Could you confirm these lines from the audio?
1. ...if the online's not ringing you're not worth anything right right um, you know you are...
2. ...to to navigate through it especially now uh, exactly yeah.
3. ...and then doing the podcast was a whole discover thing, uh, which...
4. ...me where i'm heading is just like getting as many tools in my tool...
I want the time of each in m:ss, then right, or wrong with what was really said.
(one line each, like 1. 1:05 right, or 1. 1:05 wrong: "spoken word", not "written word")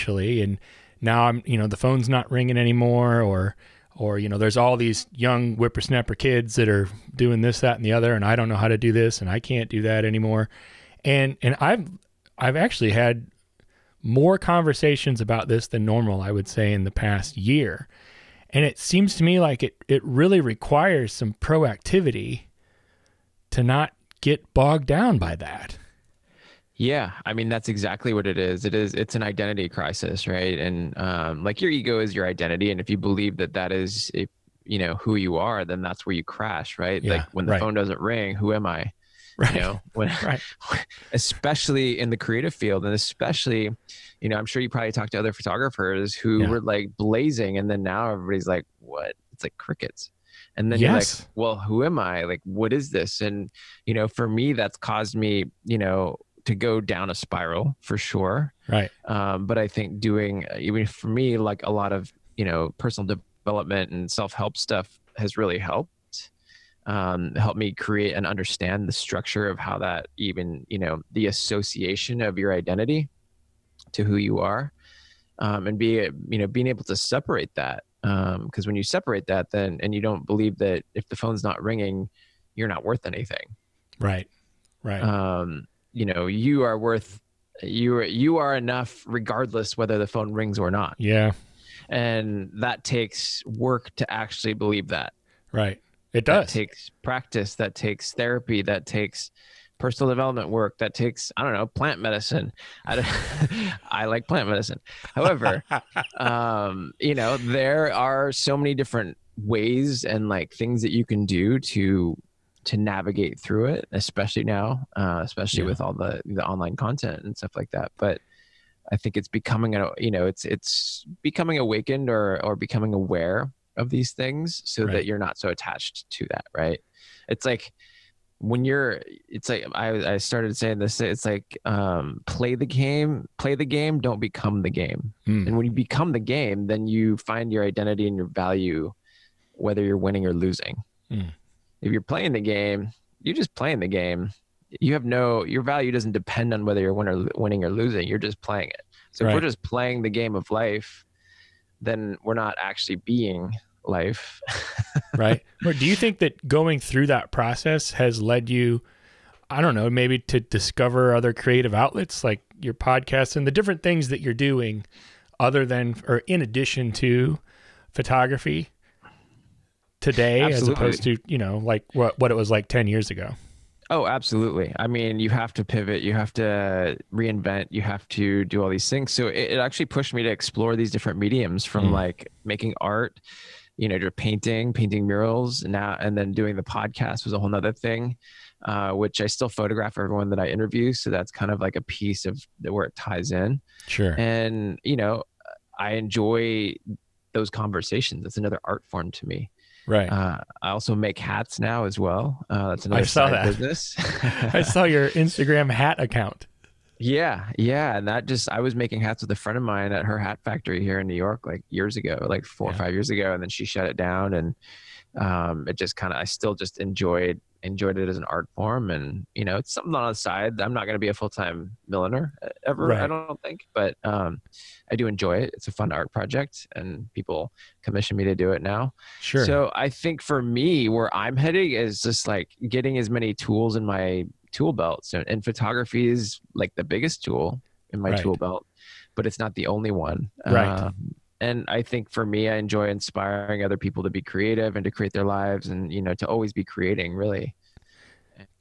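1. 1:20 wrong: "phone", not "online"
2. 1:51 wrong: "especially", not "exactly"
3. 3:05 wrong: "nother", not "discover"
4. 3:50 right.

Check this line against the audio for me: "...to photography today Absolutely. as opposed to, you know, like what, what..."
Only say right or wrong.
right.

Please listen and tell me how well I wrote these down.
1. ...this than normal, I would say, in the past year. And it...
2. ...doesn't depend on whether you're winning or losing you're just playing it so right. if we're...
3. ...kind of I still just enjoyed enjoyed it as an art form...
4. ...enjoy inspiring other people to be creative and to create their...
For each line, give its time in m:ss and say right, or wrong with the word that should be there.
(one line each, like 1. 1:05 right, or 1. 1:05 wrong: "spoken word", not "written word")
1. 0:15 right
2. 2:25 right
3. 3:35 right
4. 4:02 right.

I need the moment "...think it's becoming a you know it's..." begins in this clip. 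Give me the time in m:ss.
1:58.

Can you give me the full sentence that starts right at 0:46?
were like blazing and then now everybody's like what it's like crickets and then yes.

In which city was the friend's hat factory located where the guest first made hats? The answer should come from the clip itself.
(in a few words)
New York.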